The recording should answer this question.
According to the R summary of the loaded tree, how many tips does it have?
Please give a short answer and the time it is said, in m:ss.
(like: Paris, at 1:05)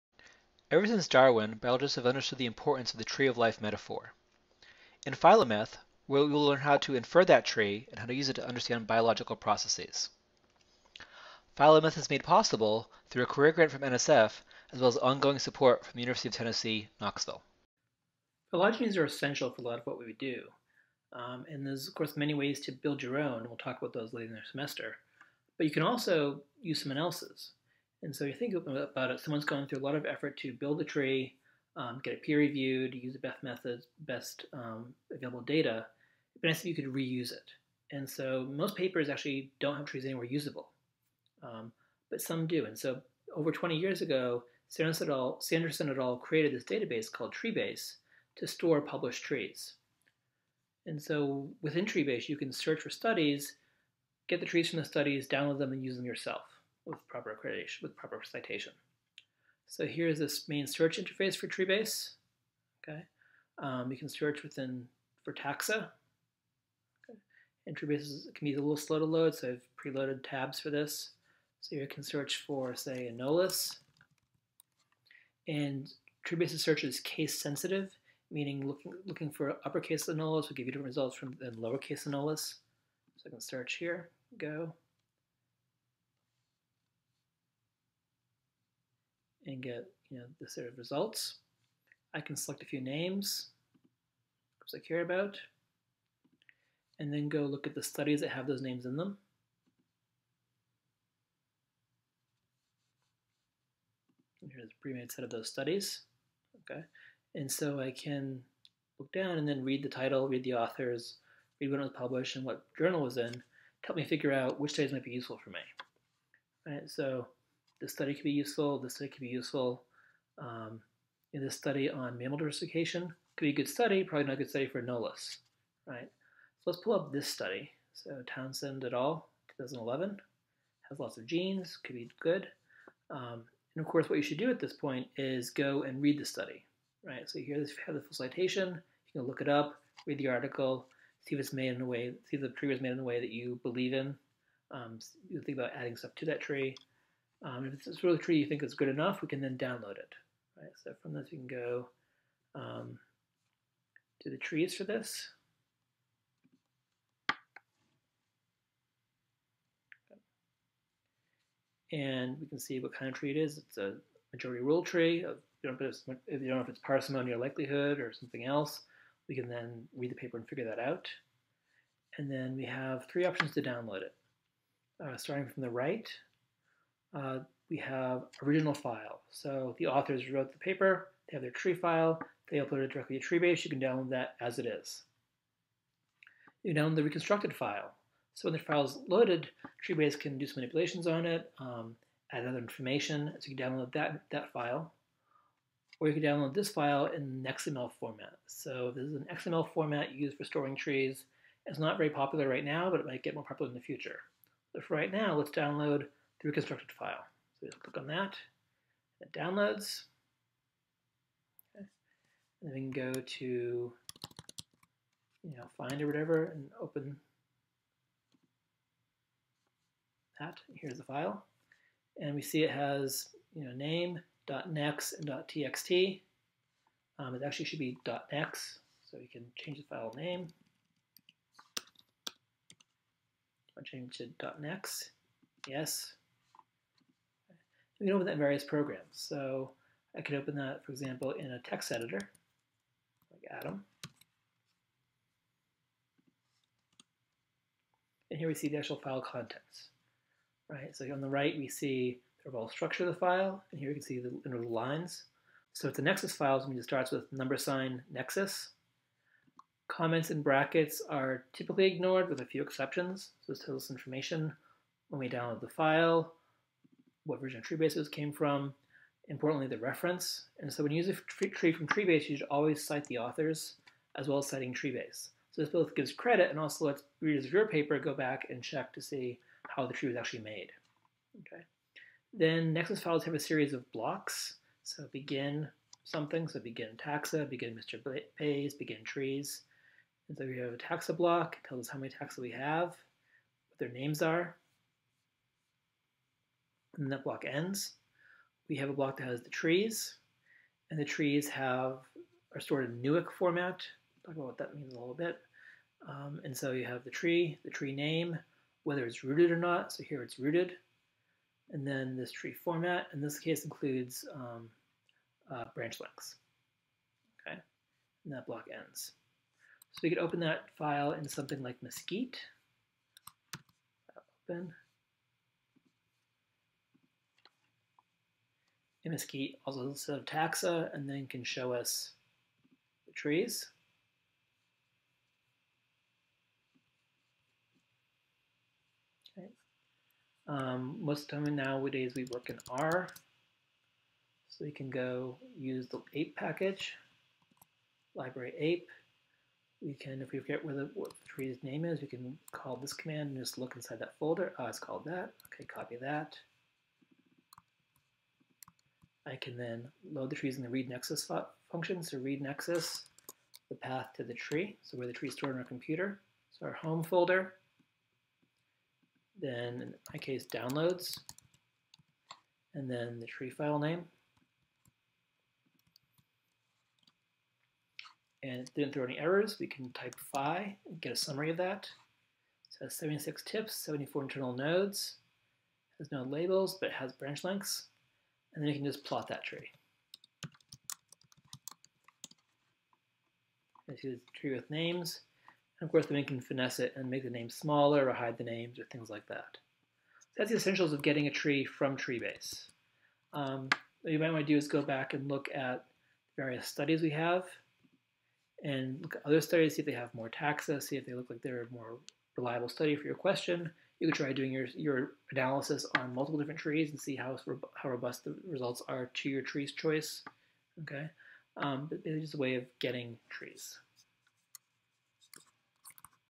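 76, at 6:22.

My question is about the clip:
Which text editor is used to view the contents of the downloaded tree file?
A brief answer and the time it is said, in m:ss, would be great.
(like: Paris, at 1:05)
Atom, at 4:03.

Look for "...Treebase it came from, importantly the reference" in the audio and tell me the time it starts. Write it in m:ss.
4:27.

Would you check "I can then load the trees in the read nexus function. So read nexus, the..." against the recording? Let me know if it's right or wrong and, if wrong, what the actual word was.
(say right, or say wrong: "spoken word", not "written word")
right.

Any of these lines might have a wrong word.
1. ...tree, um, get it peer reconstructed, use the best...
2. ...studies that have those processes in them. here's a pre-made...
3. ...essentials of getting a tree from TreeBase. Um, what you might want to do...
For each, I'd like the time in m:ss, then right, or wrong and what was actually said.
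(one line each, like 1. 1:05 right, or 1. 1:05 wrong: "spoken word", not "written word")
1. 0:30 wrong: "reviewed", not "reconstructed"
2. 1:37 wrong: "names", not "processes"
3. 6:40 right.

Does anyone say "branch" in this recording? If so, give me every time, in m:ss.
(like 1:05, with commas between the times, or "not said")
5:15, 6:27.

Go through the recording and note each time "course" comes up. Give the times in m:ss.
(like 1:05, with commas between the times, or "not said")
0:21, 2:13, 6:35.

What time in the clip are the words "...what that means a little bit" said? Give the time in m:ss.
5:04.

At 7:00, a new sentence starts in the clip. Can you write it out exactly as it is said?
Okay, um, but it's just a way of getting trees.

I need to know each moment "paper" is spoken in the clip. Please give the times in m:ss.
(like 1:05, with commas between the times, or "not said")
0:38, 2:50, 3:00, 4:37.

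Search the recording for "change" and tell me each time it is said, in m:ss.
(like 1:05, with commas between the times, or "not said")
3:49, 3:53.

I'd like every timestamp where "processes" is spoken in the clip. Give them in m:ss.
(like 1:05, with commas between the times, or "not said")
0:09.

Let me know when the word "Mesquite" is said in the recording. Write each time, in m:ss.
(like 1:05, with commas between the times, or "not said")
5:21, 5:29.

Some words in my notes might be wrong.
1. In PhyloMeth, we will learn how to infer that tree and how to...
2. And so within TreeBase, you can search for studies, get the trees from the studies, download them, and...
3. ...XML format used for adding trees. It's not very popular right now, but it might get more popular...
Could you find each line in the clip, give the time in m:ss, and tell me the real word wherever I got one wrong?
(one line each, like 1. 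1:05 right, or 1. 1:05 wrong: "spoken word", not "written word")
1. 0:05 right
2. 0:50 right
3. 3:19 wrong: "storing", not "adding".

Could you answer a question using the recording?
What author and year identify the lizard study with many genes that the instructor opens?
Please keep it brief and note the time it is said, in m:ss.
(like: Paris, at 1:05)
Townsend et al., 2011, at 2:08.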